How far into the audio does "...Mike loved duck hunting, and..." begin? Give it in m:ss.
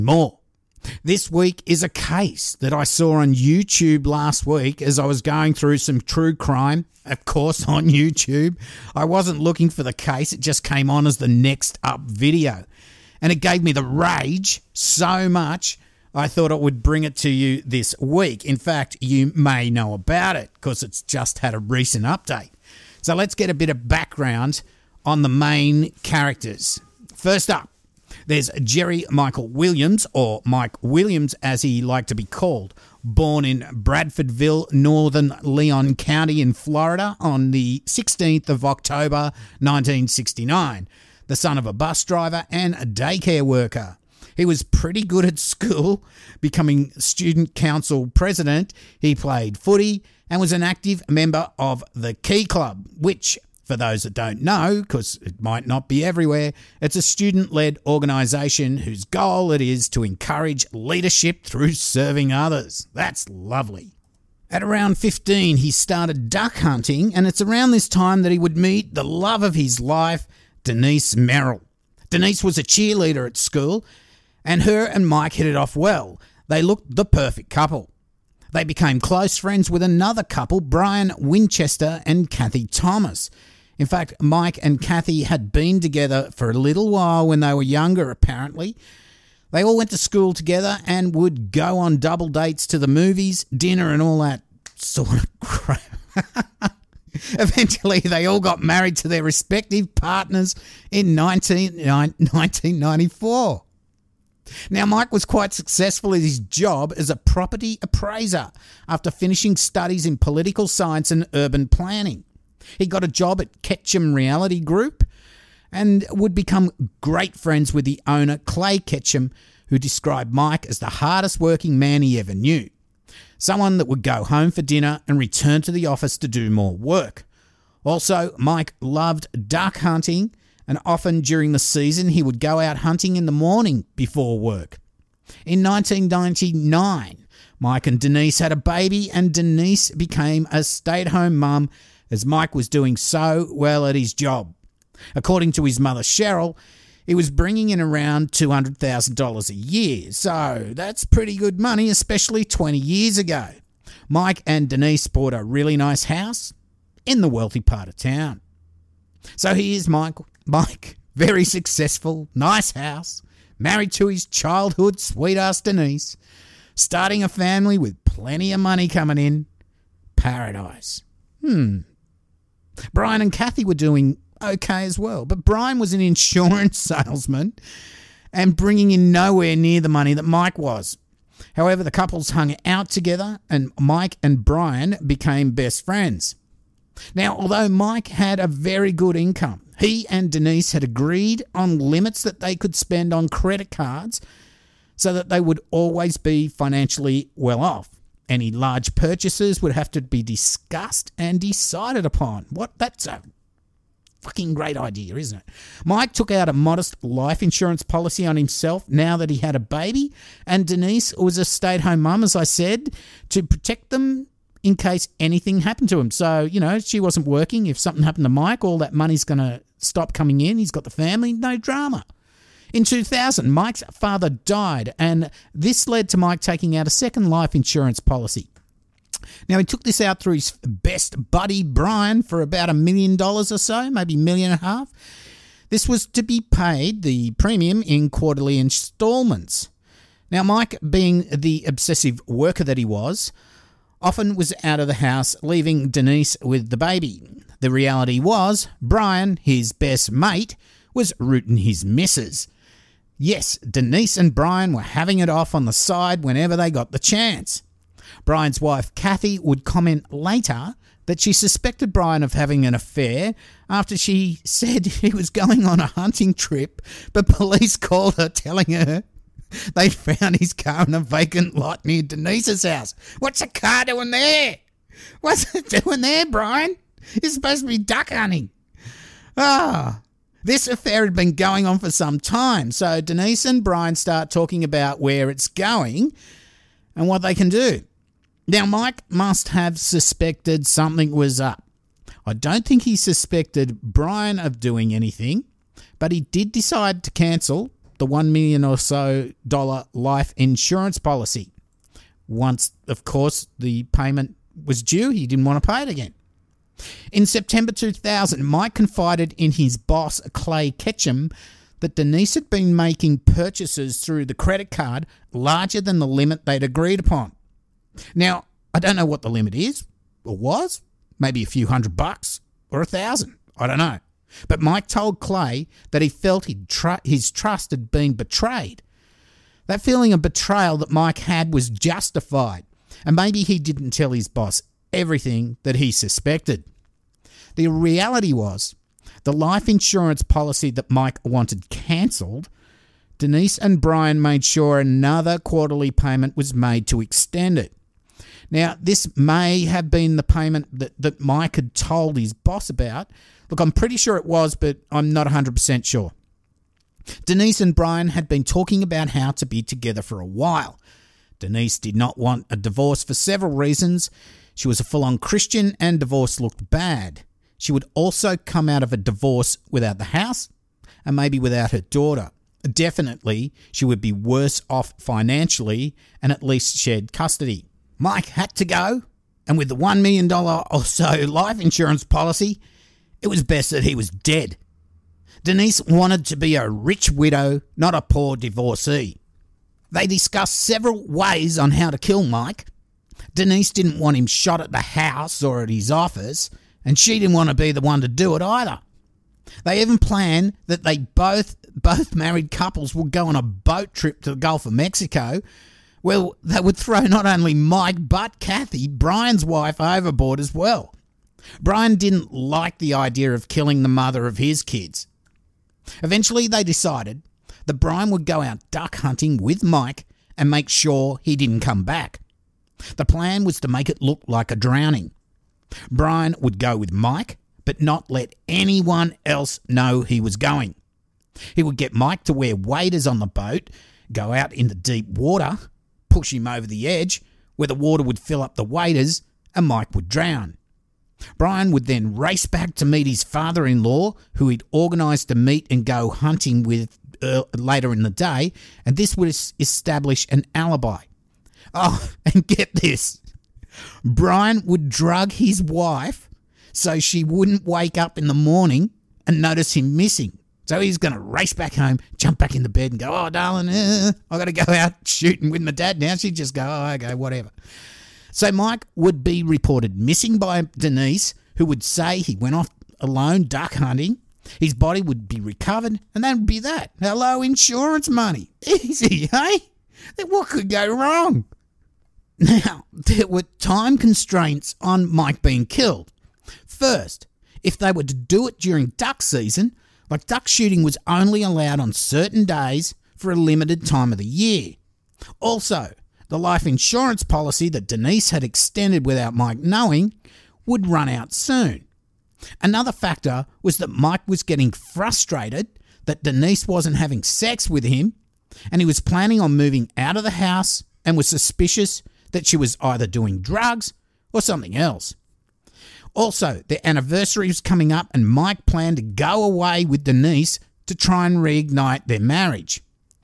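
2:08.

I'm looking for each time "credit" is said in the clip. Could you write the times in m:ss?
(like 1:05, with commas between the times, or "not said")
3:13, 5:14.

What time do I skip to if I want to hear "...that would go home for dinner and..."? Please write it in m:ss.
2:03.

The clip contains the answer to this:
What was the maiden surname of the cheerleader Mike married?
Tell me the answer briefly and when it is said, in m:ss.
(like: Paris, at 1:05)
Merrill, at 1:11.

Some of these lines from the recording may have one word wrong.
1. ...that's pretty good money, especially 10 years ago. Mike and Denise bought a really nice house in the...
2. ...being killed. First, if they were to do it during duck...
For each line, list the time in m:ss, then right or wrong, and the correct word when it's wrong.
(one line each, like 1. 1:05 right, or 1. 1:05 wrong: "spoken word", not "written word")
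1. 2:30 wrong: "20", not "10"
2. 8:05 right.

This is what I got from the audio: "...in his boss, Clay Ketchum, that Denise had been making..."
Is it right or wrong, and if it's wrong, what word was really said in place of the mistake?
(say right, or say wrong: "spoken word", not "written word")
right.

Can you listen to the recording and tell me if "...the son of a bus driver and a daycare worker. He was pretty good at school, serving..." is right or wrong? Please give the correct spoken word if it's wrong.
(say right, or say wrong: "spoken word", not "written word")
wrong: "becoming", not "serving".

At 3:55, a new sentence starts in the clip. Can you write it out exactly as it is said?
This was to be paid, the premium, in quarterly installments.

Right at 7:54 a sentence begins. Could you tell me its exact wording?
His body would be recovered, and that would be that.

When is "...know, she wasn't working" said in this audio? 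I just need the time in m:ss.
3:36.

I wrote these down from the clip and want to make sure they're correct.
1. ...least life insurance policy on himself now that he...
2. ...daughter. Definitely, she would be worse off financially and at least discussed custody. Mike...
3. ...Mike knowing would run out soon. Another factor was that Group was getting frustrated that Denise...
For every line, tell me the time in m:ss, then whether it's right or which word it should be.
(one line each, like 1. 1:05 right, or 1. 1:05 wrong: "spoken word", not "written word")
1. 3:26 wrong: "modest", not "least"
2. 6:11 wrong: "shared", not "discussed"
3. 8:19 wrong: "Mike", not "Group".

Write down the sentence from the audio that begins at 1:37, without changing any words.
Eventually, they all got married to their respective partners in 1994.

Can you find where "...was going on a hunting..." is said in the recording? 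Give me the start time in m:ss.
4:25.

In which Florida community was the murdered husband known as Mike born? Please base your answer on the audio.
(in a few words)
Bradfordville.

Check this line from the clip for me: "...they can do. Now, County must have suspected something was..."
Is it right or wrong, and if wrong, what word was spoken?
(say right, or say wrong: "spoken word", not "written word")
wrong: "Mike", not "County".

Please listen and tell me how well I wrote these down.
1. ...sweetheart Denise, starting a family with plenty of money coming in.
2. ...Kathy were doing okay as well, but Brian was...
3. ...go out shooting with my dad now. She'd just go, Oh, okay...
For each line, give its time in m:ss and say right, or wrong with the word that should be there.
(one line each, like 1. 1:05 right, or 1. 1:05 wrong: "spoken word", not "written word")
1. 2:45 right
2. 2:53 right
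3. 7:44 right.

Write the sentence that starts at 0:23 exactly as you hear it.
So let's get a bit of background on the main characters.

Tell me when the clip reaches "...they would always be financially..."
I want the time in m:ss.
3:15.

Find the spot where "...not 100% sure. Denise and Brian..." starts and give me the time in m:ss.
5:55.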